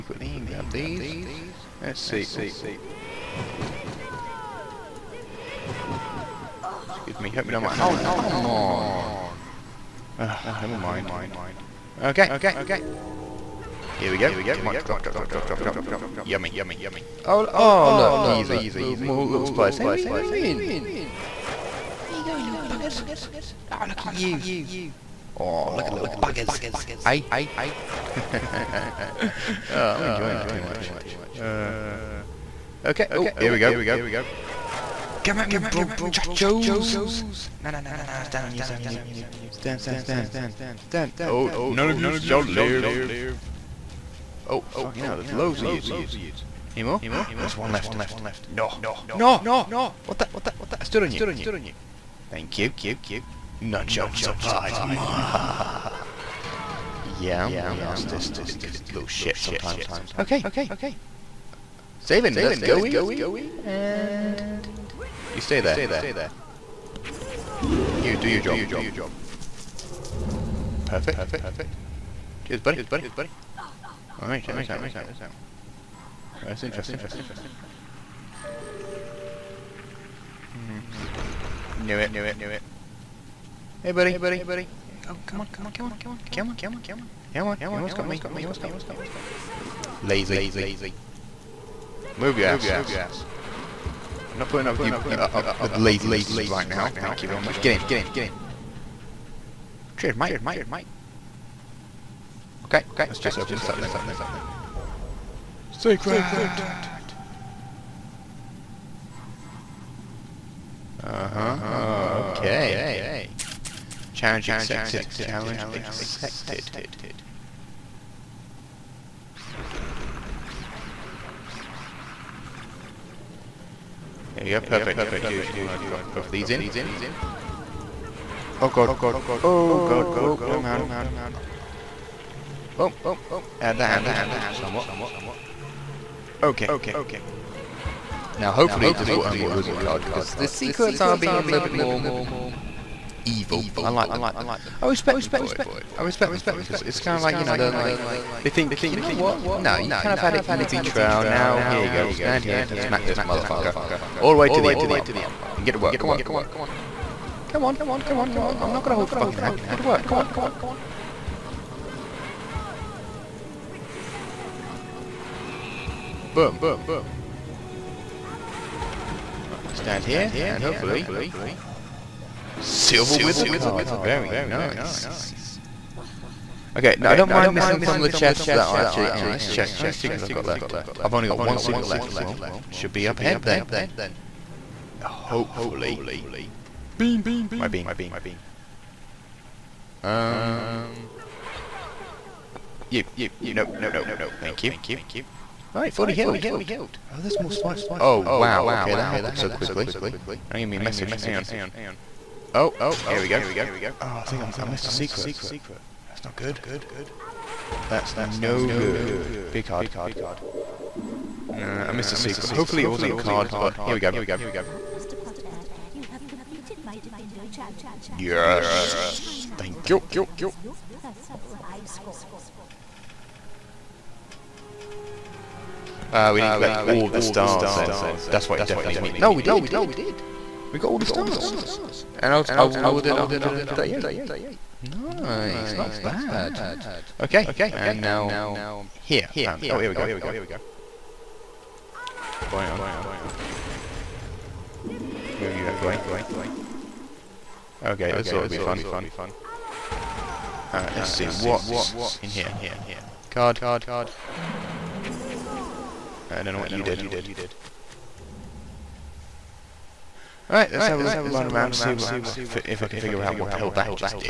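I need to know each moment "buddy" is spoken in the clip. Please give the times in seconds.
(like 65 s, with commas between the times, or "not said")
72 s, 83 s.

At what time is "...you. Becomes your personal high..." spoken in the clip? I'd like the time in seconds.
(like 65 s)
219 s.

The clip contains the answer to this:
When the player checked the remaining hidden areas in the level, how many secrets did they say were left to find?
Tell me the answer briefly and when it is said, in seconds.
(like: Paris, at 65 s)
1, at 181 s.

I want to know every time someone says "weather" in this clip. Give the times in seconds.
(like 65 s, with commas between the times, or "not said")
not said.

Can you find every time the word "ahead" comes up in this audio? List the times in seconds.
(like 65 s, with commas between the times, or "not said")
183 s.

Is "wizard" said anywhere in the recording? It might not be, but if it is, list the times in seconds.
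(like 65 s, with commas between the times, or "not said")
139 s, 173 s.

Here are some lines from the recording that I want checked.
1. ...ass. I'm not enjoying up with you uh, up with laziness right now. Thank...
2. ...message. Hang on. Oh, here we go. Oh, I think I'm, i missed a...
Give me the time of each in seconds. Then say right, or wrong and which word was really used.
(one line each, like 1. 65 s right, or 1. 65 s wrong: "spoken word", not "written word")
1. 92 s wrong: "putting", not "enjoying"
2. 200 s right.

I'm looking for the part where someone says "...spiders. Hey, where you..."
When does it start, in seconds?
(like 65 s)
19 s.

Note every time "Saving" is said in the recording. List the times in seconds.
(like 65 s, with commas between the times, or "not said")
61 s.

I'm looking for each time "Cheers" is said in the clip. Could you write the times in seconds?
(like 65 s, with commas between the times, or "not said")
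72 s, 99 s.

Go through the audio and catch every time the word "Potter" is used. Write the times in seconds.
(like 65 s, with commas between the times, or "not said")
215 s.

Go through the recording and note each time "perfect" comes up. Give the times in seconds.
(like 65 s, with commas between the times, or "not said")
70 s, 124 s.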